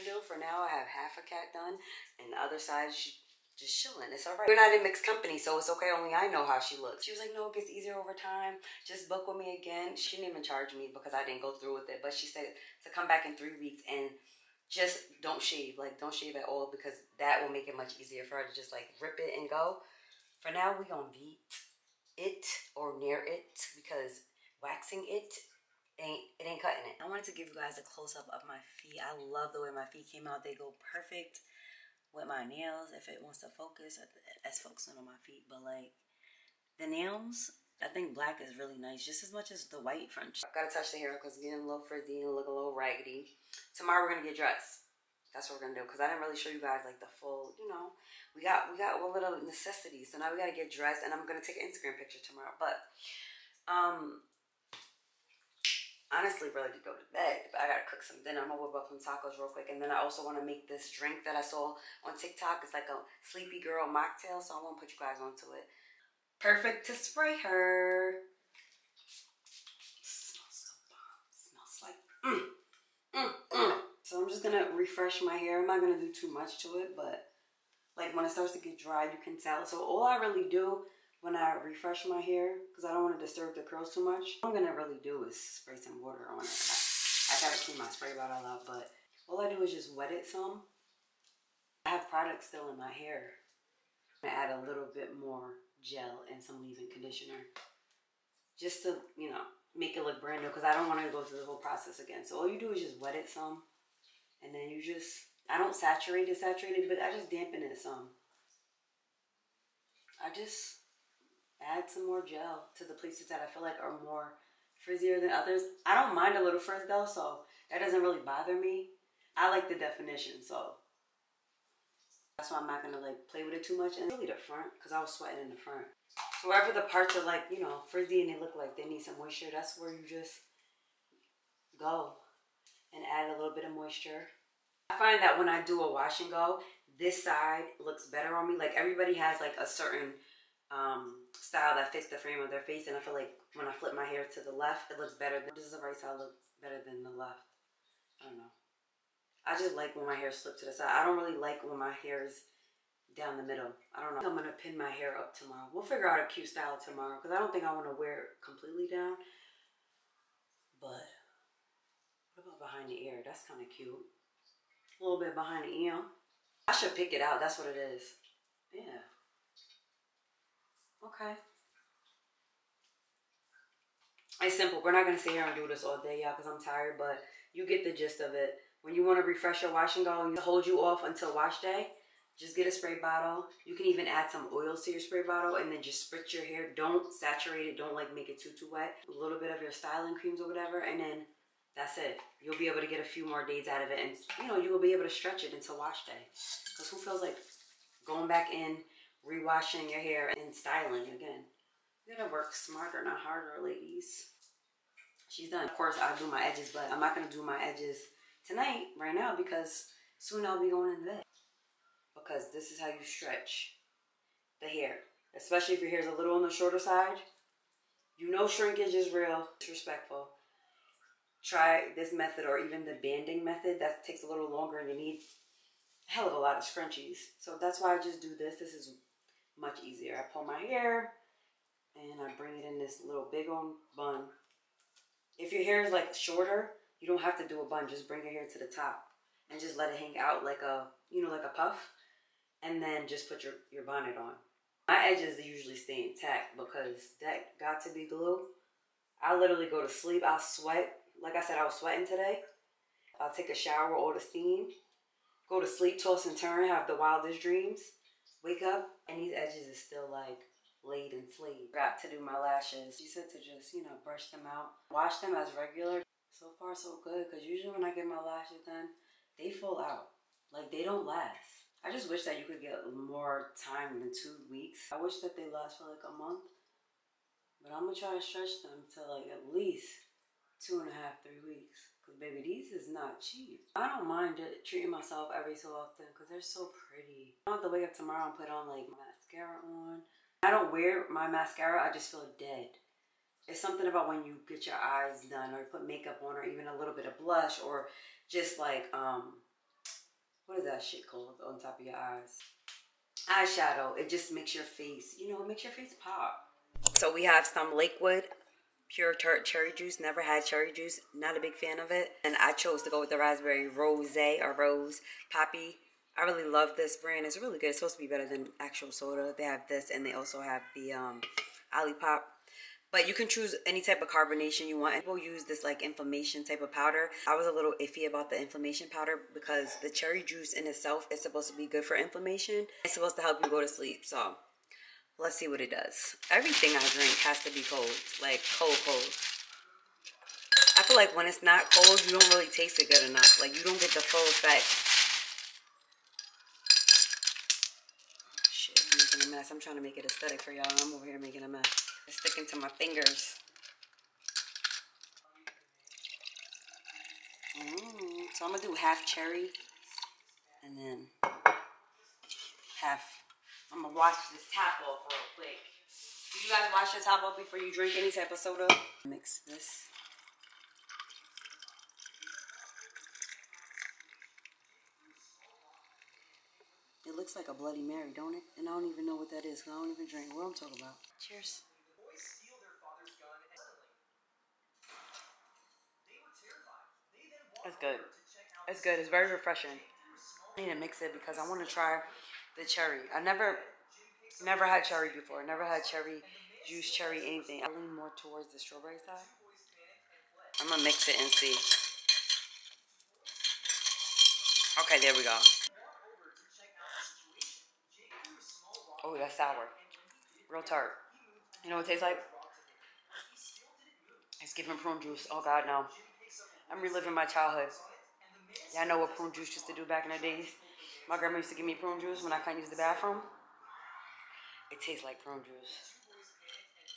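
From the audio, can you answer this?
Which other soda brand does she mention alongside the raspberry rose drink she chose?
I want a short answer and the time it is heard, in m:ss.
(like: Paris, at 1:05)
Olipop, at 5:21.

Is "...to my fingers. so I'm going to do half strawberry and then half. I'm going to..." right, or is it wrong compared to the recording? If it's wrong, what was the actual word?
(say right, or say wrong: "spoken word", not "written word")
wrong: "cherry", not "strawberry".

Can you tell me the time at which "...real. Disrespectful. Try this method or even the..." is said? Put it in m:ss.
3:39.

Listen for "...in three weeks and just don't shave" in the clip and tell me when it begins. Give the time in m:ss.
0:13.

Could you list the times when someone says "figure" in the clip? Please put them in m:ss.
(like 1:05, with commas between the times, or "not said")
2:35.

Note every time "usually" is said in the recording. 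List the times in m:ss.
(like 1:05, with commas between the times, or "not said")
4:05, 4:27.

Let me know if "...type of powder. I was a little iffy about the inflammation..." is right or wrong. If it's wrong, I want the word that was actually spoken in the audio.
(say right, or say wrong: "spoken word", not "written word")
right.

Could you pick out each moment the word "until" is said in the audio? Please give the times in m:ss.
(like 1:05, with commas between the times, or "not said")
3:01, 3:15.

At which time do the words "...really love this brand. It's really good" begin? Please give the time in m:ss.
5:16.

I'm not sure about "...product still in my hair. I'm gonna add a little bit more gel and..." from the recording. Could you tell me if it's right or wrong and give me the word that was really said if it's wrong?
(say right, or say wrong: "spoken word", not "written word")
right.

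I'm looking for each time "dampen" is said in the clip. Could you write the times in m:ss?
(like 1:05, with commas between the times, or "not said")
1:47.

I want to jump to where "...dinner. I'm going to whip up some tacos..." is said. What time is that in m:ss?
0:58.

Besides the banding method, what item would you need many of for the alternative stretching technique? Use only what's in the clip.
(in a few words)
Scrunchies.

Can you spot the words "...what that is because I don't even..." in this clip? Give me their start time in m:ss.
6:19.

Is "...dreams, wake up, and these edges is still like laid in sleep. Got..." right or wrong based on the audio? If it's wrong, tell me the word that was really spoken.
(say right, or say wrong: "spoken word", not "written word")
right.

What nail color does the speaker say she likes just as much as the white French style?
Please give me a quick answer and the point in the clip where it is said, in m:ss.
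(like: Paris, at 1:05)
Black, at 0:38.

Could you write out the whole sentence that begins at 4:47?
I don't have to wake up tomorrow and put on like mascara on I don't wear my mascara, I just feel dead.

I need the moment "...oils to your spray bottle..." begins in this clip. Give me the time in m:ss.
3:04.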